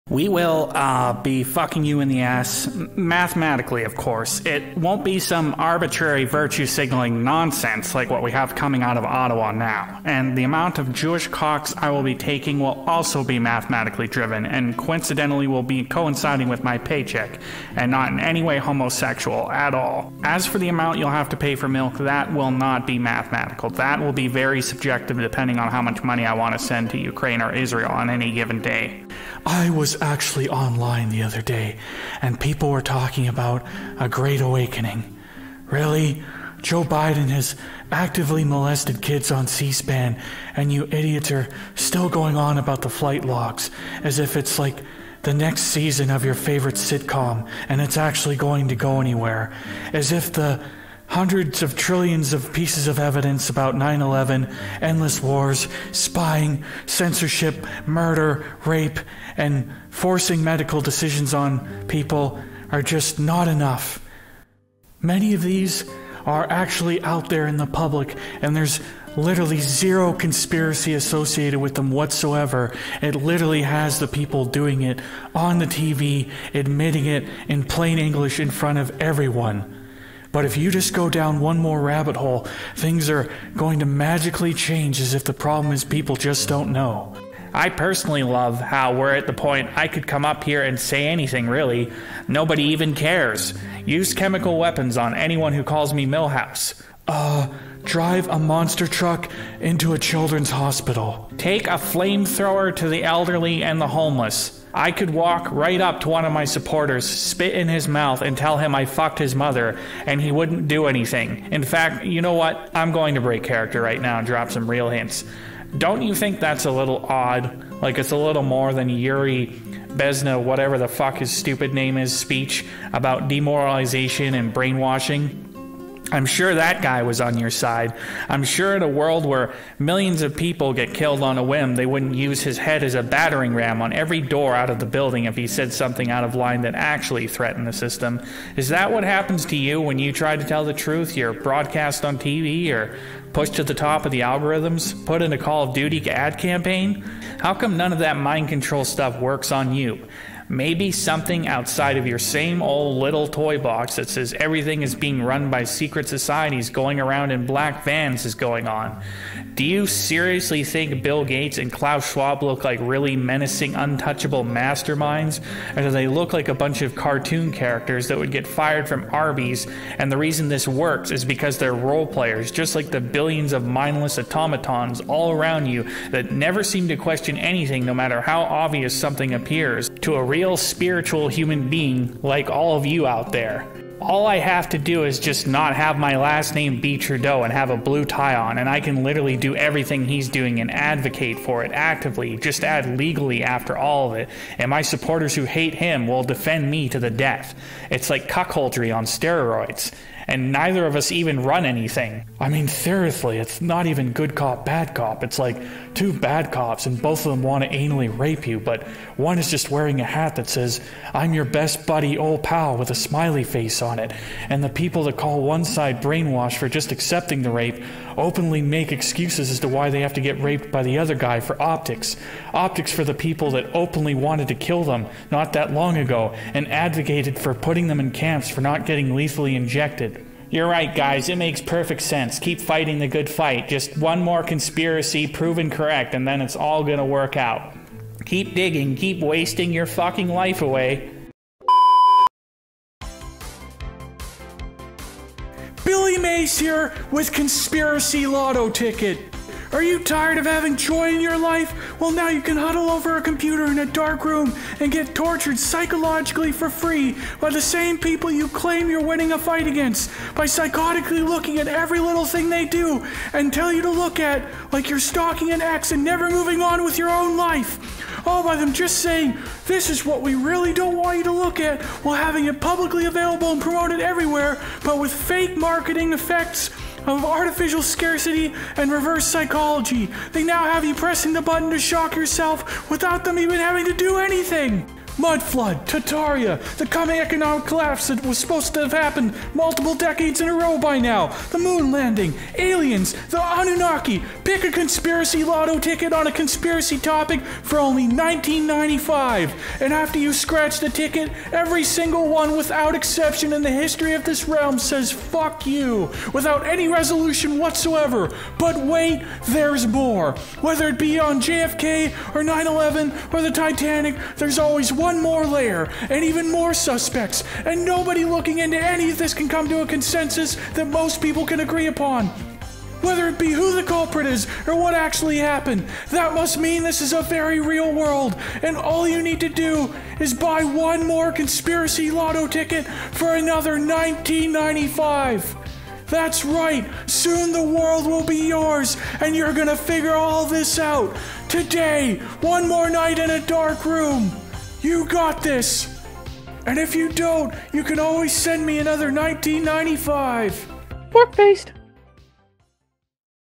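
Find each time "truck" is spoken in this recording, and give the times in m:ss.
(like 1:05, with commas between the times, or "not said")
1:38.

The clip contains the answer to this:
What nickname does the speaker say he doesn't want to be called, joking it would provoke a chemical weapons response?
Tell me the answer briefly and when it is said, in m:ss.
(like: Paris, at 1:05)
Milhouse, at 1:36.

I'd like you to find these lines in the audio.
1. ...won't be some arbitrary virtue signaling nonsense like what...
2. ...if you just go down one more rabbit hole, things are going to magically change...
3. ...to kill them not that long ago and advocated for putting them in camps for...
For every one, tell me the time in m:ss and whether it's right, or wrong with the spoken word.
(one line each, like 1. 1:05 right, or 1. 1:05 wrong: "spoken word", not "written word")
1. 0:04 right
2. 1:20 right
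3. 3:44 right.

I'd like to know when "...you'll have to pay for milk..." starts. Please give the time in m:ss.
0:20.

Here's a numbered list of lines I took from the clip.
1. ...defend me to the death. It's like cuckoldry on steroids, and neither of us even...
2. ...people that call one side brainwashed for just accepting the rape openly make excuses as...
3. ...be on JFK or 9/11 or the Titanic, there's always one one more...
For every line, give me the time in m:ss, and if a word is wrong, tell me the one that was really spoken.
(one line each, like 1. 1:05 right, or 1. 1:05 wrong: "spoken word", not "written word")
1. 3:16 right
2. 3:34 right
3. 5:10 right.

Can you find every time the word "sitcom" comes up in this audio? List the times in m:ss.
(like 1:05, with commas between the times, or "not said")
0:46.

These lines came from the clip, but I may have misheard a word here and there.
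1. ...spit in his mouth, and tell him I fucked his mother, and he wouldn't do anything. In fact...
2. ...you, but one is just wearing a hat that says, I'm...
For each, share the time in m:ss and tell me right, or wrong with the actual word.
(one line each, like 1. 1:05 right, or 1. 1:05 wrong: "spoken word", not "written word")
1. 1:47 right
2. 3:28 right.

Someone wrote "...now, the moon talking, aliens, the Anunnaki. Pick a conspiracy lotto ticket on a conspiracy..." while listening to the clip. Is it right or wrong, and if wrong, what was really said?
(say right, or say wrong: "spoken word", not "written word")
wrong: "landing", not "talking".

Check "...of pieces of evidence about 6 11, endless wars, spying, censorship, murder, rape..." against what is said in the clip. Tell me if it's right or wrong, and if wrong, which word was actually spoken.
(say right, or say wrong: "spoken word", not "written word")
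wrong: "9", not "6".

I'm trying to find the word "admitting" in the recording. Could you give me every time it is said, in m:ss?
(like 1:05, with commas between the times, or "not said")
1:16.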